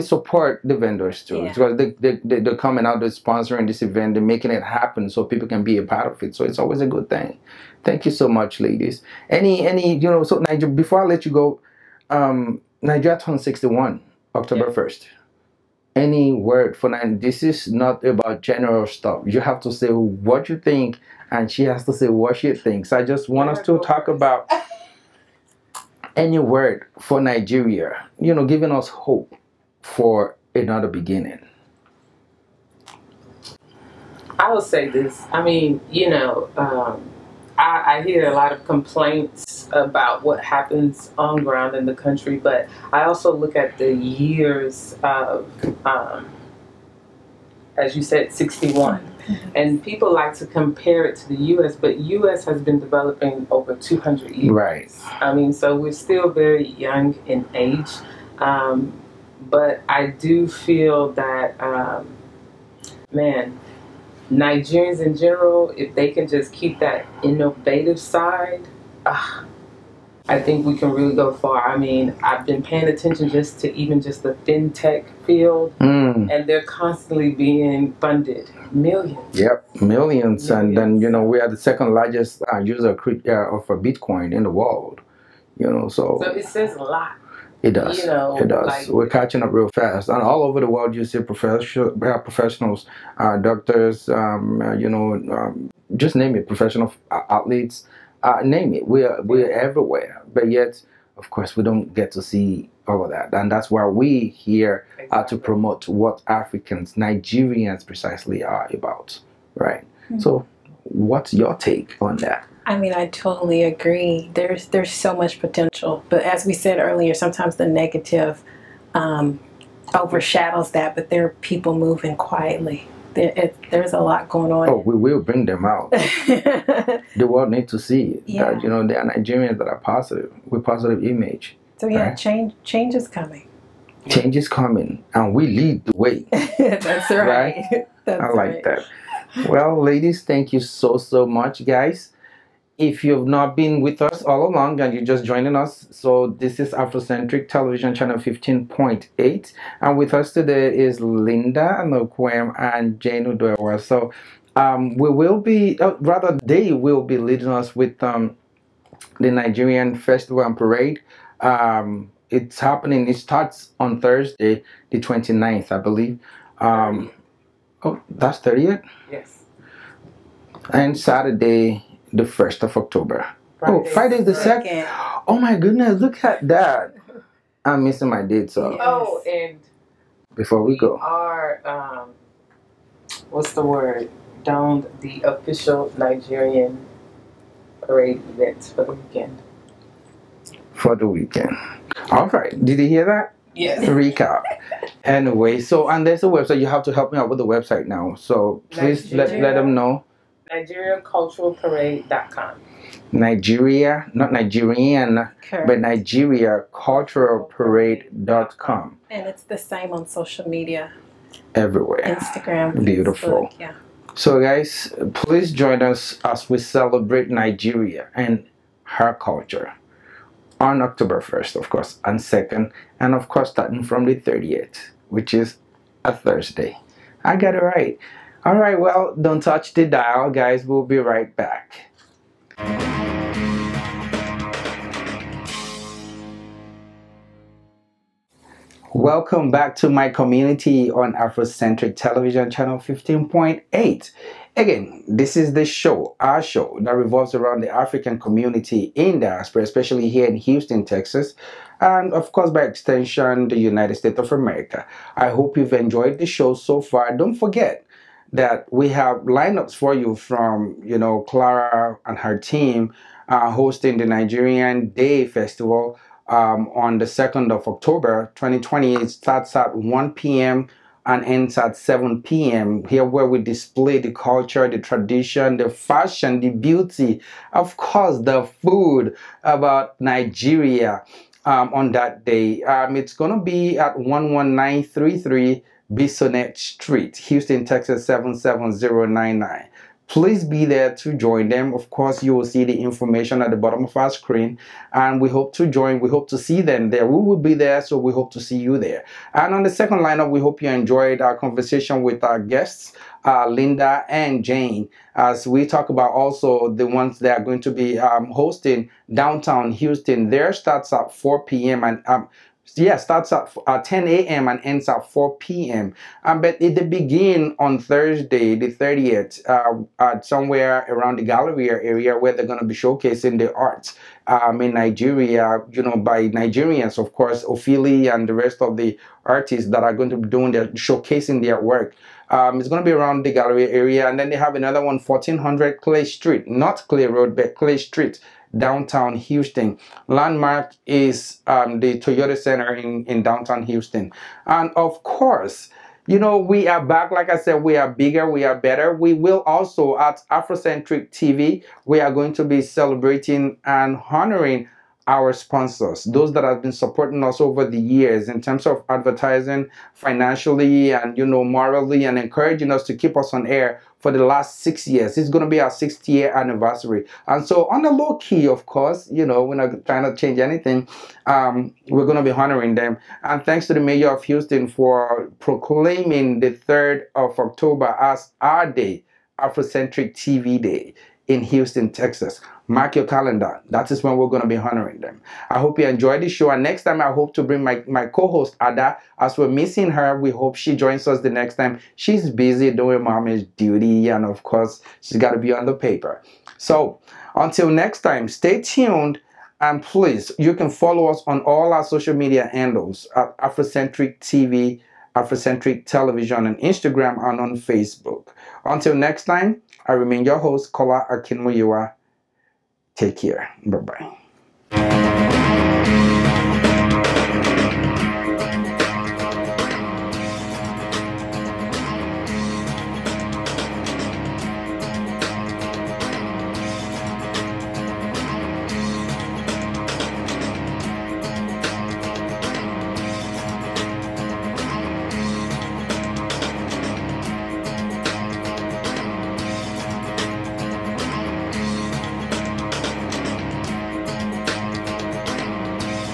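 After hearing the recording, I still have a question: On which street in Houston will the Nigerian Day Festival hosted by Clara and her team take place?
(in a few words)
Bissonnet Street.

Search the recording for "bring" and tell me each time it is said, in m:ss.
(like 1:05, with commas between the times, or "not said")
2:05, 6:27.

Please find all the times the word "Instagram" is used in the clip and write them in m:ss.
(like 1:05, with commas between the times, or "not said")
3:32, 6:46.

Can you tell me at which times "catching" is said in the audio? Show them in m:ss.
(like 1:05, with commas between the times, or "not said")
1:29.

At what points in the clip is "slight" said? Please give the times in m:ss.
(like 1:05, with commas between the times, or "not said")
not said.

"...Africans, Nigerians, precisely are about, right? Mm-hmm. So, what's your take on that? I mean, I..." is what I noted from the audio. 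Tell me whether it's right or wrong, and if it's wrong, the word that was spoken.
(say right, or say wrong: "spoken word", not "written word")
right.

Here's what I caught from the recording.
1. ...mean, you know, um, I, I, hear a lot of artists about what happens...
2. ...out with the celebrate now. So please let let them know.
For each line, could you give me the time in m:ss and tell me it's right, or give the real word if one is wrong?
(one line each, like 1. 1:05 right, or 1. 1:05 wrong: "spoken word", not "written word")
1. 0:35 wrong: "complaints", not "artists"
2. 3:17 wrong: "website", not "celebrate".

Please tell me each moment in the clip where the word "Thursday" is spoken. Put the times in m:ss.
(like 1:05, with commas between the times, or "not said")
2:44, 3:46, 5:17.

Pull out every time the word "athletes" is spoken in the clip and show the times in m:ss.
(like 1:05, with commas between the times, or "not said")
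1:37.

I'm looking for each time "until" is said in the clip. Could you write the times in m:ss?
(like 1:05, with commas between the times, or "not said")
6:37, 6:48.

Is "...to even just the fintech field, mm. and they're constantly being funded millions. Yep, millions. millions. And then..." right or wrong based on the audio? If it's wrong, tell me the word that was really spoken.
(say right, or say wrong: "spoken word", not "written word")
right.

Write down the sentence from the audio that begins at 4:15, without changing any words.
I hope you've enjoyed the show so far.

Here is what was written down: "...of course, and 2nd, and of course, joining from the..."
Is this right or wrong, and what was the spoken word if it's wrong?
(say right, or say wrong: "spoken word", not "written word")
wrong: "starting", not "joining".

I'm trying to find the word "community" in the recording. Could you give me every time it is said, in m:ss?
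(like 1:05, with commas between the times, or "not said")
4:00, 4:08.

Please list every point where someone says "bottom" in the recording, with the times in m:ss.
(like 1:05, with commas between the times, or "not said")
4:53.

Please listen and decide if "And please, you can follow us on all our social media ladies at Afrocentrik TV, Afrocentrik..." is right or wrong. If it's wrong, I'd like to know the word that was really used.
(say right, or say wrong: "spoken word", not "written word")
wrong: "handles", not "ladies".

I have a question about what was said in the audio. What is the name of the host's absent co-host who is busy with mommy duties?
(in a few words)
Ada.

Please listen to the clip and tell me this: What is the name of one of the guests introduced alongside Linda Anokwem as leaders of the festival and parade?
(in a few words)
Jane Udoewa.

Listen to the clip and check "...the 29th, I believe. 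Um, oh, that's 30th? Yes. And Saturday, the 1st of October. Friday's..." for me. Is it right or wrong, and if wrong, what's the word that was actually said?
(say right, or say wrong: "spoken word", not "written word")
right.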